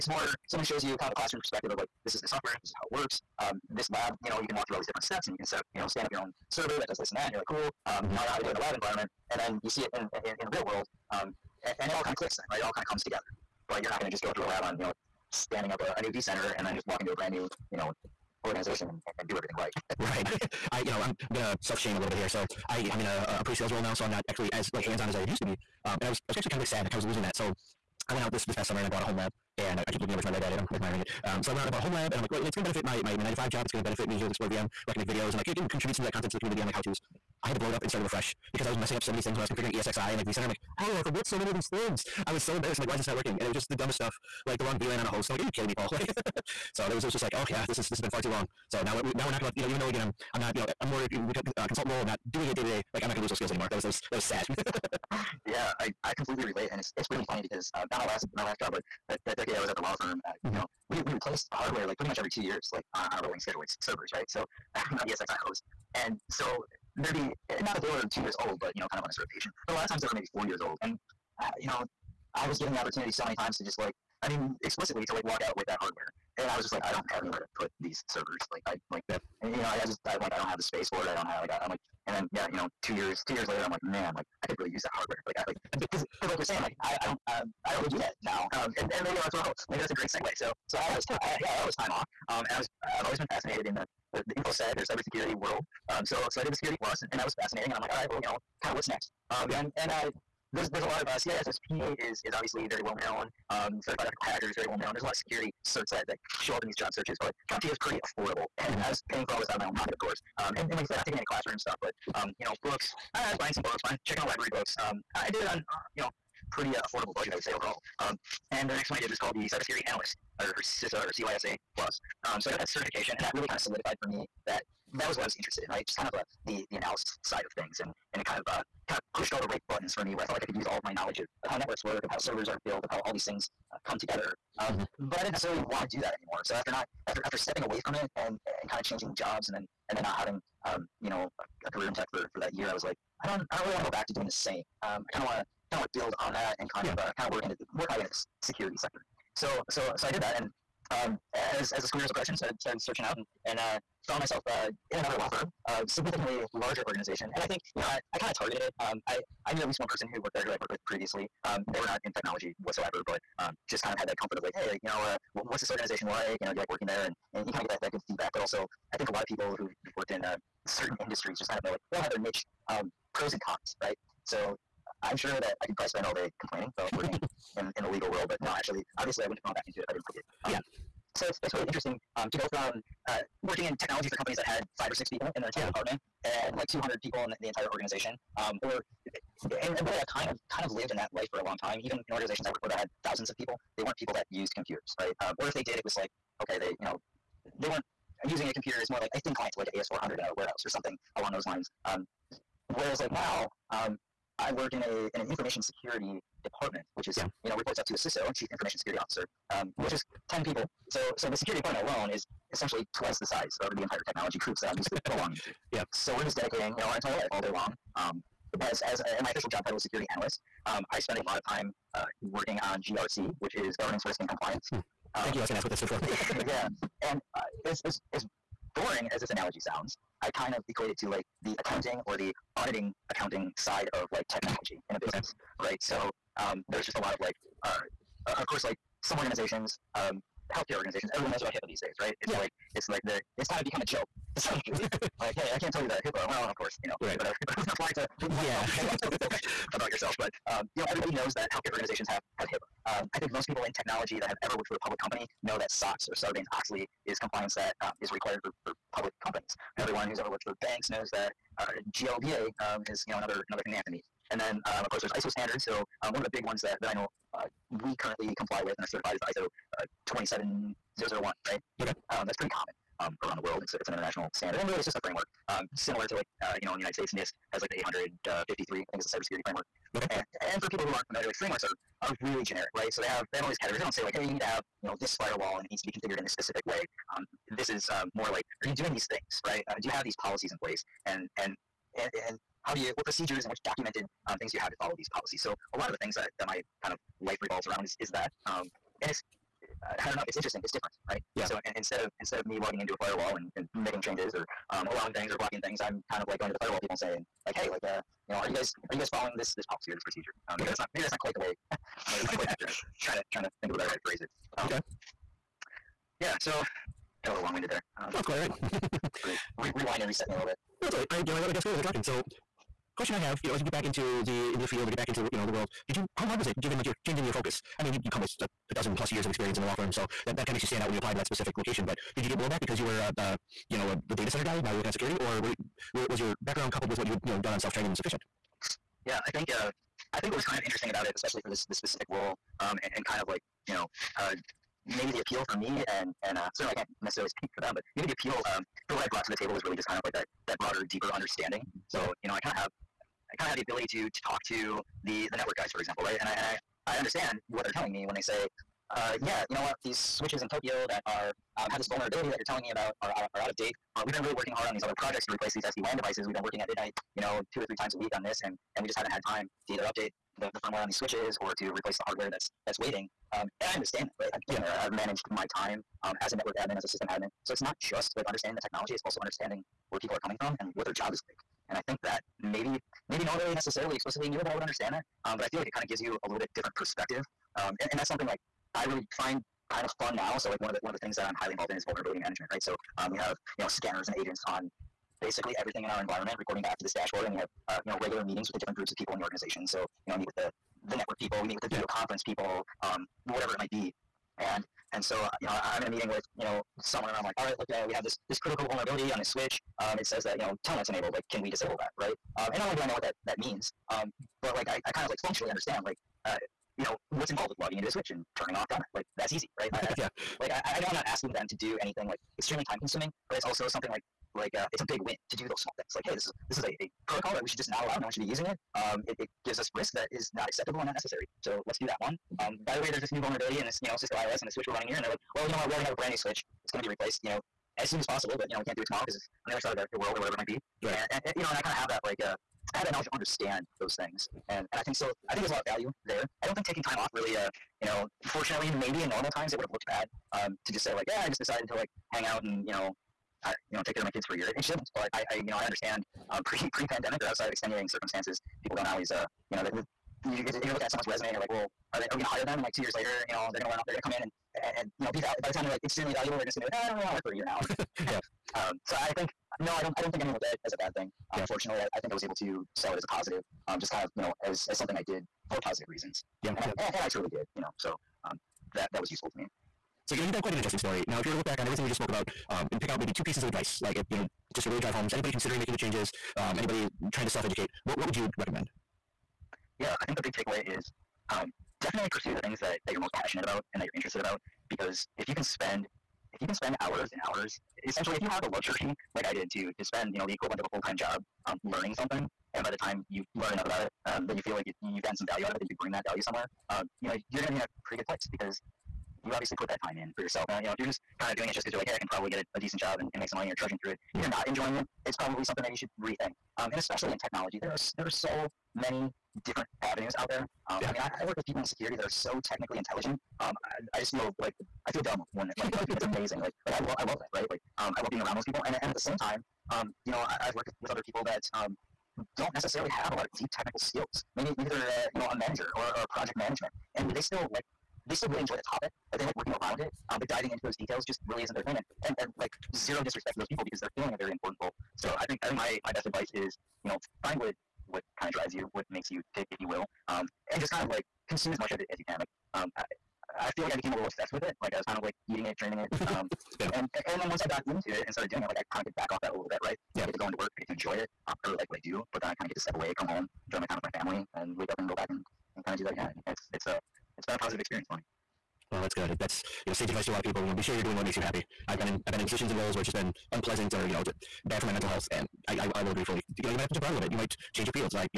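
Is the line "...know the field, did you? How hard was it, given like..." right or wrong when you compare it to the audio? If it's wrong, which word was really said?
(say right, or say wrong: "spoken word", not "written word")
wrong: "world", not "field".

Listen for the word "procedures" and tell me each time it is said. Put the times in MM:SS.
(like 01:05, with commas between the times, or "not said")
04:53, 05:10.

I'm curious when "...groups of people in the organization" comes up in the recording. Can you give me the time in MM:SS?
06:38.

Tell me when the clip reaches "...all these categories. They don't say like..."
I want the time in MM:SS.
04:43.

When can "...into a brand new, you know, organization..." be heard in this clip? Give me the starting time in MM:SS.
00:17.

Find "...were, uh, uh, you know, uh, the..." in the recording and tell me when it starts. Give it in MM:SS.
05:32.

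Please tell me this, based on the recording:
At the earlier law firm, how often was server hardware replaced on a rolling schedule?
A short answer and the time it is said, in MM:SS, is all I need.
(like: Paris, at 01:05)
Every two years, at 01:02.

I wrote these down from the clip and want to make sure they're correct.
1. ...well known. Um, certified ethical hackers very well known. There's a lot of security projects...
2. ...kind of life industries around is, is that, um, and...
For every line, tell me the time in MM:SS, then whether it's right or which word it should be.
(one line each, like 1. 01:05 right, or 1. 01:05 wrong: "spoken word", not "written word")
1. 01:42 wrong: "certs", not "projects"
2. 04:56 wrong: "revolves", not "industries".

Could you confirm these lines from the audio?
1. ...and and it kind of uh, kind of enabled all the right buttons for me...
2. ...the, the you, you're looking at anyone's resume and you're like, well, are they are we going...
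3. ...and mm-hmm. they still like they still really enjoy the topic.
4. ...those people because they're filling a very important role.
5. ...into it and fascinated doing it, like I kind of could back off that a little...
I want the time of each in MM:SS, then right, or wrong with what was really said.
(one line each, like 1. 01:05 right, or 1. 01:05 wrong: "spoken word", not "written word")
1. 02:07 wrong: "pushed", not "enabled"
2. 07:39 wrong: "someone", not "anyone"
3. 08:56 right
4. 09:03 right
5. 09:17 wrong: "started", not "fascinated".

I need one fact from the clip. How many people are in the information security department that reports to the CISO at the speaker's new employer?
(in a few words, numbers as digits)
10.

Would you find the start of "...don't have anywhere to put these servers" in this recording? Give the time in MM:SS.
01:16.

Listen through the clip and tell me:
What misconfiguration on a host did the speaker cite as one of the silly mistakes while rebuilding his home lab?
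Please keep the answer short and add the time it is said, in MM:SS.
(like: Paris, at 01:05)
Wrong VLAN, at 00:44.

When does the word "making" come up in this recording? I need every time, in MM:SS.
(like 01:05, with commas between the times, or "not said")
05:03, 08:05.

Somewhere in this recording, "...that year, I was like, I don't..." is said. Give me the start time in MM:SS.
02:22.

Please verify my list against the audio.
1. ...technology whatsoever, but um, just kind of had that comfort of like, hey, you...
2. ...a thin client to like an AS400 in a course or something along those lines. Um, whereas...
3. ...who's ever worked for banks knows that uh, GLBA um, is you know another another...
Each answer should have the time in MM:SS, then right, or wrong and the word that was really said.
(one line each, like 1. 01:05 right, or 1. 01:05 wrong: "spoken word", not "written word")
1. 02:42 right
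2. 03:19 wrong: "warehouse", not "course"
3. 04:20 right.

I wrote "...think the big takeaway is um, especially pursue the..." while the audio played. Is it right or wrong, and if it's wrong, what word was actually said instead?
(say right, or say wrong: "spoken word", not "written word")
wrong: "definitely", not "especially".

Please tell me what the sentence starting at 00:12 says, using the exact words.
It all kind of comes together.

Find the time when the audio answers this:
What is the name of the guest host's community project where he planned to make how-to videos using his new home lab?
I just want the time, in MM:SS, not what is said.
00:34.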